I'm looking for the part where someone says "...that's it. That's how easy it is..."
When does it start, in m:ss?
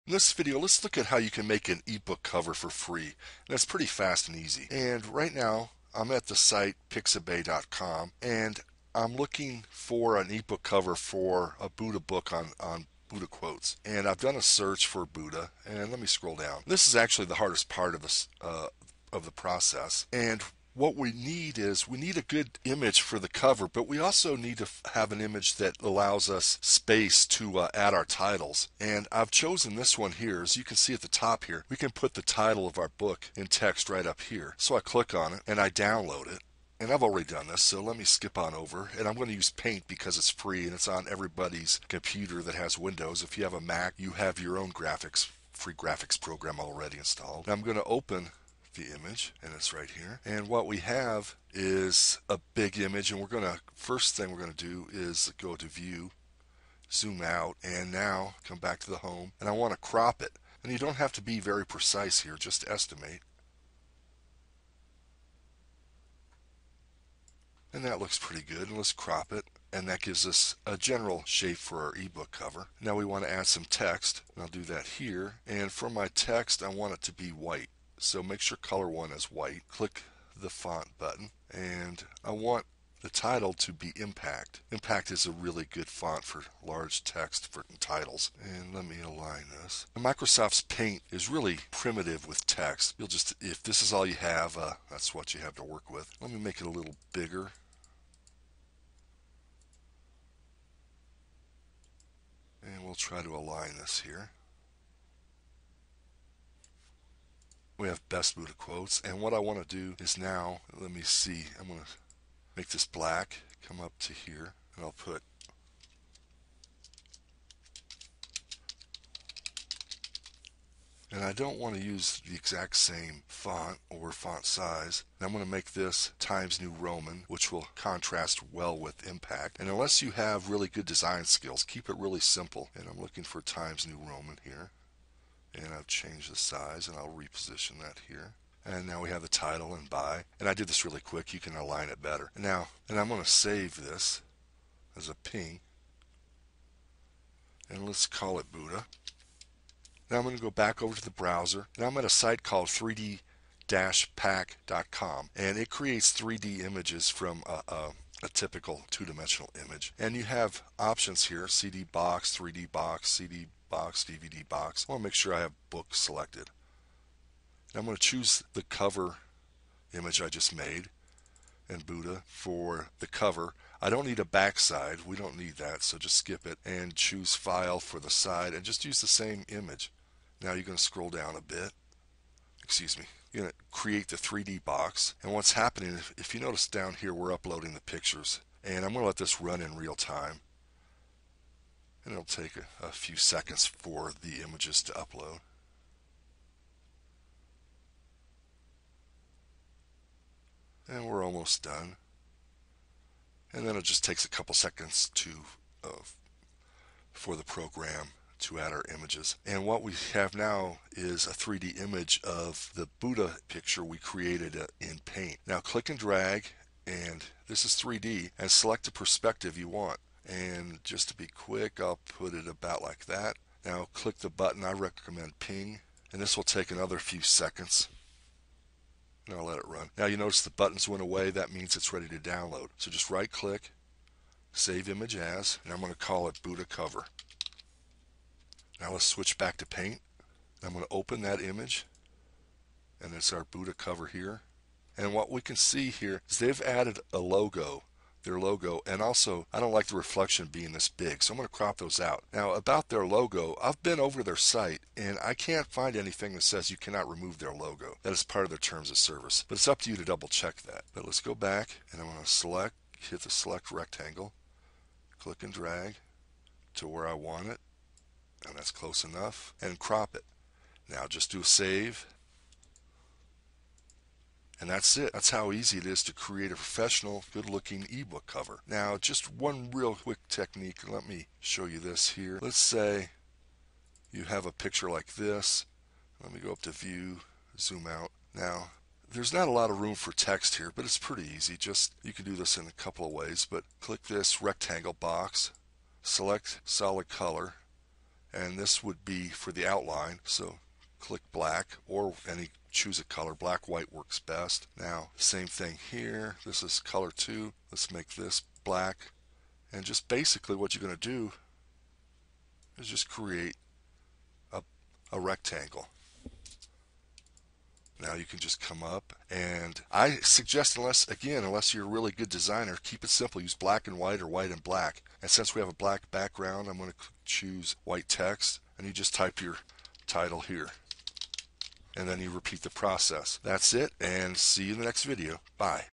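4:34.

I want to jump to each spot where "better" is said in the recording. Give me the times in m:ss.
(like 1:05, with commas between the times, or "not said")
2:22.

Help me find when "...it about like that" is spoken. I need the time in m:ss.
3:42.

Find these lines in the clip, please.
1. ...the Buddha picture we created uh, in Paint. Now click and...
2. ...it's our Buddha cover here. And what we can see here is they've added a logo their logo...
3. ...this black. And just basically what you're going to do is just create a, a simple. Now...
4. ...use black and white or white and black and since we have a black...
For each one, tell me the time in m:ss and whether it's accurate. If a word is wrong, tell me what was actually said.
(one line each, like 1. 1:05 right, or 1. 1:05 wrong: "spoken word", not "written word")
1. 3:32 right
2. 4:03 right
3. 5:08 wrong: "rectangle", not "simple"
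4. 5:23 right.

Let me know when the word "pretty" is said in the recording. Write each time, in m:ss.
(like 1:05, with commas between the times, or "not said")
0:03, 1:08, 4:50.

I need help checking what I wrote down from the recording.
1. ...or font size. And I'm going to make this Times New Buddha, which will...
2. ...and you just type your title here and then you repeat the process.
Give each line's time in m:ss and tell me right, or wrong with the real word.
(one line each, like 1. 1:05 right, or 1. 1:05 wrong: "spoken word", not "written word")
1. 2:03 wrong: "Roman", not "Buddha"
2. 5:28 right.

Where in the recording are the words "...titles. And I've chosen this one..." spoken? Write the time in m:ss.
0:28.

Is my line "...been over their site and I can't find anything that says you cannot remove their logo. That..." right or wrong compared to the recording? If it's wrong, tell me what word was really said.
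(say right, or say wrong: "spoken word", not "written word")
right.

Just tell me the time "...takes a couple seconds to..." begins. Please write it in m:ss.
3:24.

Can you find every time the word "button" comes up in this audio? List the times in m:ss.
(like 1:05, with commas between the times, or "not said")
1:20, 3:44, 3:50.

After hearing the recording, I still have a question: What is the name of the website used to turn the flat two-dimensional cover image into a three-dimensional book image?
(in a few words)
3d-pack.com.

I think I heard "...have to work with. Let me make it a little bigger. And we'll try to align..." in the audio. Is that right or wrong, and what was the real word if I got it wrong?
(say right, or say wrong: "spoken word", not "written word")
right.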